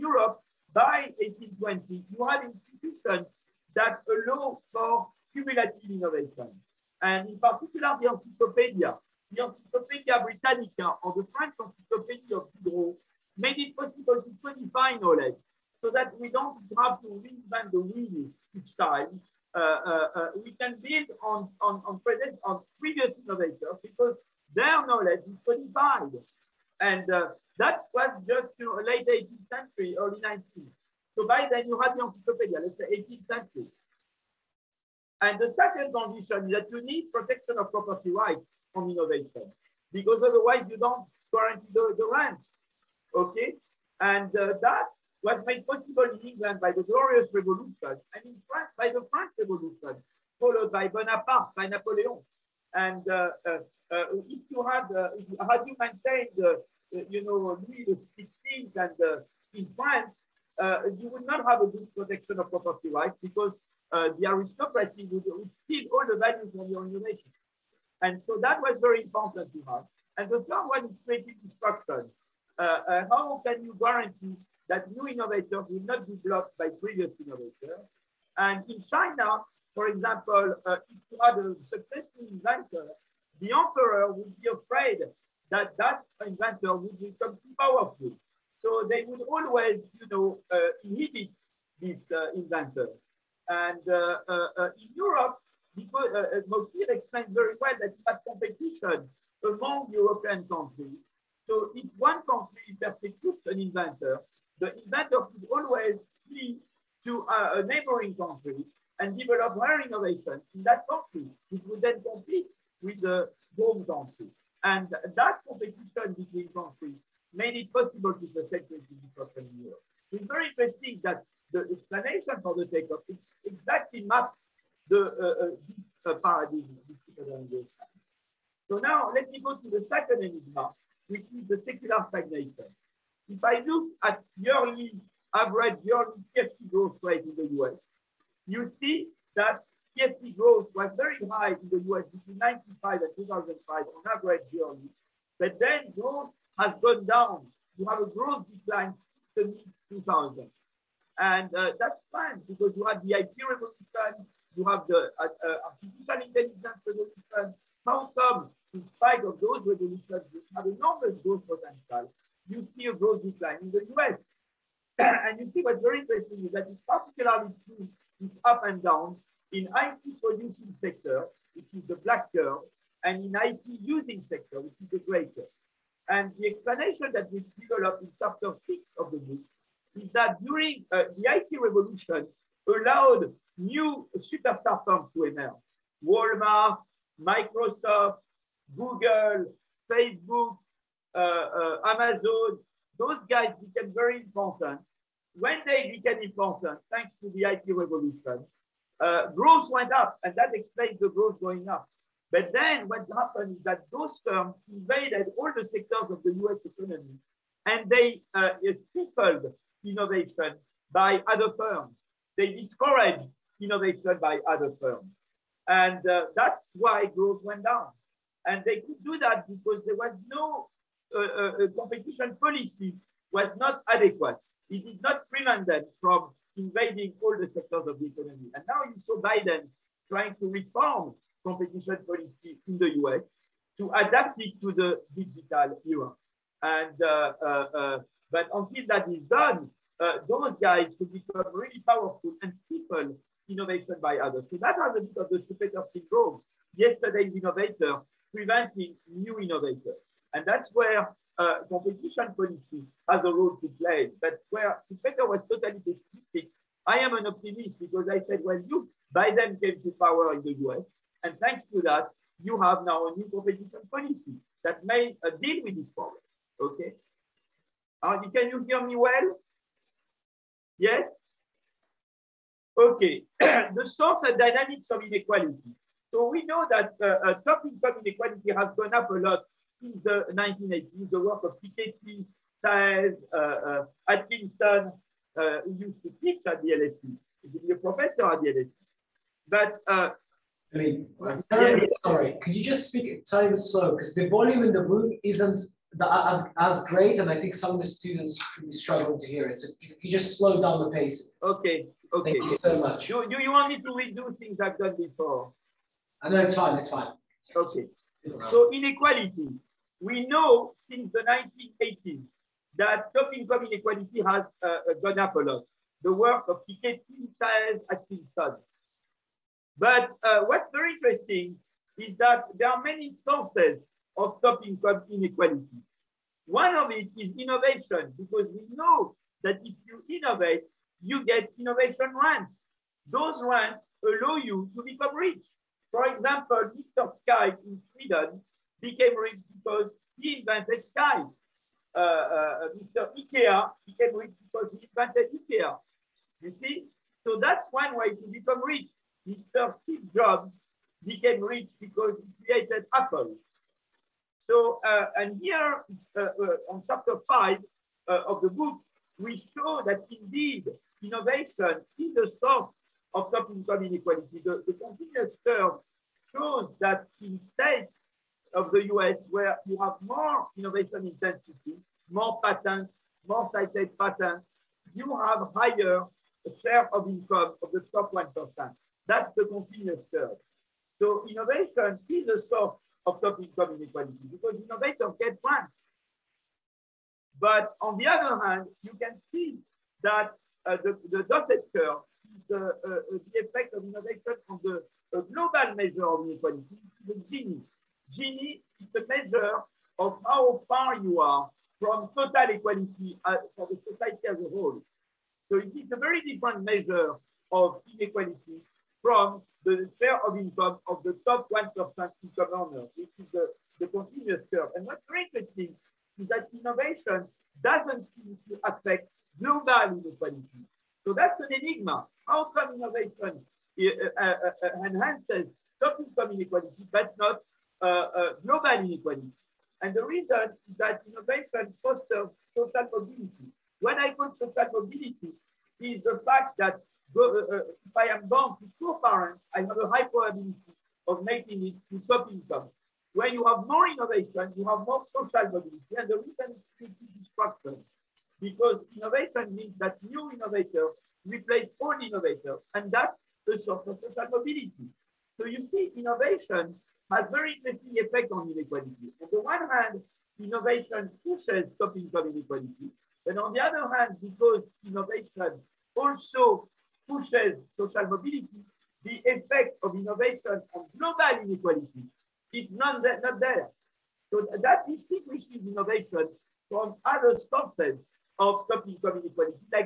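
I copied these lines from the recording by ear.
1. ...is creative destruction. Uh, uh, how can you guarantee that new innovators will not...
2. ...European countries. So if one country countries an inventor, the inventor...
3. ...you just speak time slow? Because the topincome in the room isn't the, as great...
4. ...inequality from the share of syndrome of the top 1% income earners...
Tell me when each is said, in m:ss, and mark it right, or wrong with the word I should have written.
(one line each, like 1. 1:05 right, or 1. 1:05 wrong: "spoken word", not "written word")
1. 1:10 right
2. 1:39 wrong: "persecutes", not "countries"
3. 4:52 wrong: "volume", not "topincome"
4. 6:47 wrong: "income", not "syndrome".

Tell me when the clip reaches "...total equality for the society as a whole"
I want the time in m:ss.
6:42.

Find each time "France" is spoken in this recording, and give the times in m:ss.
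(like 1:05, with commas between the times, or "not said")
0:48, 0:59.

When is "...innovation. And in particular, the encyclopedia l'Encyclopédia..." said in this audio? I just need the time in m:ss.
0:05.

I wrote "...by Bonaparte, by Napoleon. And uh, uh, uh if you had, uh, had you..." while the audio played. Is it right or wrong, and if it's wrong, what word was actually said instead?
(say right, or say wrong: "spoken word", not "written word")
right.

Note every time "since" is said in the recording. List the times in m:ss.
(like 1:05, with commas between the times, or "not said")
2:29, 4:39, 5:10.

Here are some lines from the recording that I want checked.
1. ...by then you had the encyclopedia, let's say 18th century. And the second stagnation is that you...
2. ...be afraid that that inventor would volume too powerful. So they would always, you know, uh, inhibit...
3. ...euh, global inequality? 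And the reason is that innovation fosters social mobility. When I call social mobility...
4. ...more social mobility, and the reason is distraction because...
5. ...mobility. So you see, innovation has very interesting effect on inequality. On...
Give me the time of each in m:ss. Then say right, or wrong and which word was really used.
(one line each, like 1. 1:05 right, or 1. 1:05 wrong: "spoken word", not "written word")
1. 0:31 wrong: "condition", not "stagnation"
2. 1:24 wrong: "become", not "volume"
3. 7:08 right
4. 7:24 right
5. 7:34 right.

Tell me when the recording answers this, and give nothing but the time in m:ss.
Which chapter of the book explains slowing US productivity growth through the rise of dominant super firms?
2:58.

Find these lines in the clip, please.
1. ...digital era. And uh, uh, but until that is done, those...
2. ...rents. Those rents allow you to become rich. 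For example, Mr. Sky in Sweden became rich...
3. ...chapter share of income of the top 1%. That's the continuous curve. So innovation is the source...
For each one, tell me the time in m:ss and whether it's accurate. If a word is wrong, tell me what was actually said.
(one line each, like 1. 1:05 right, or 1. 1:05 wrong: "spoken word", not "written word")
1. 3:55 right
2. 5:32 right
3. 6:15 wrong: "higher", not "chapter".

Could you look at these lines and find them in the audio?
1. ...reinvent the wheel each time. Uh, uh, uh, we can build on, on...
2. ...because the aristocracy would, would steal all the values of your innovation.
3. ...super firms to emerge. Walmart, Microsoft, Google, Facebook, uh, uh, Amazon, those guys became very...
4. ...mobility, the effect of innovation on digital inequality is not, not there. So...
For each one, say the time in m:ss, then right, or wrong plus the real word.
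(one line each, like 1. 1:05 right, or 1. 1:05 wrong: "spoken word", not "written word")
1. 0:17 right
2. 1:03 right
3. 3:04 right
4. 7:48 wrong: "global", not "digital".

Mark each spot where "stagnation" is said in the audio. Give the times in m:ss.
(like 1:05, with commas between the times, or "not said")
2:12.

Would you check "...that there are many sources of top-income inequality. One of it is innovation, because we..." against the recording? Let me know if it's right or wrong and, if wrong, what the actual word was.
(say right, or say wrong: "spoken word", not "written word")
right.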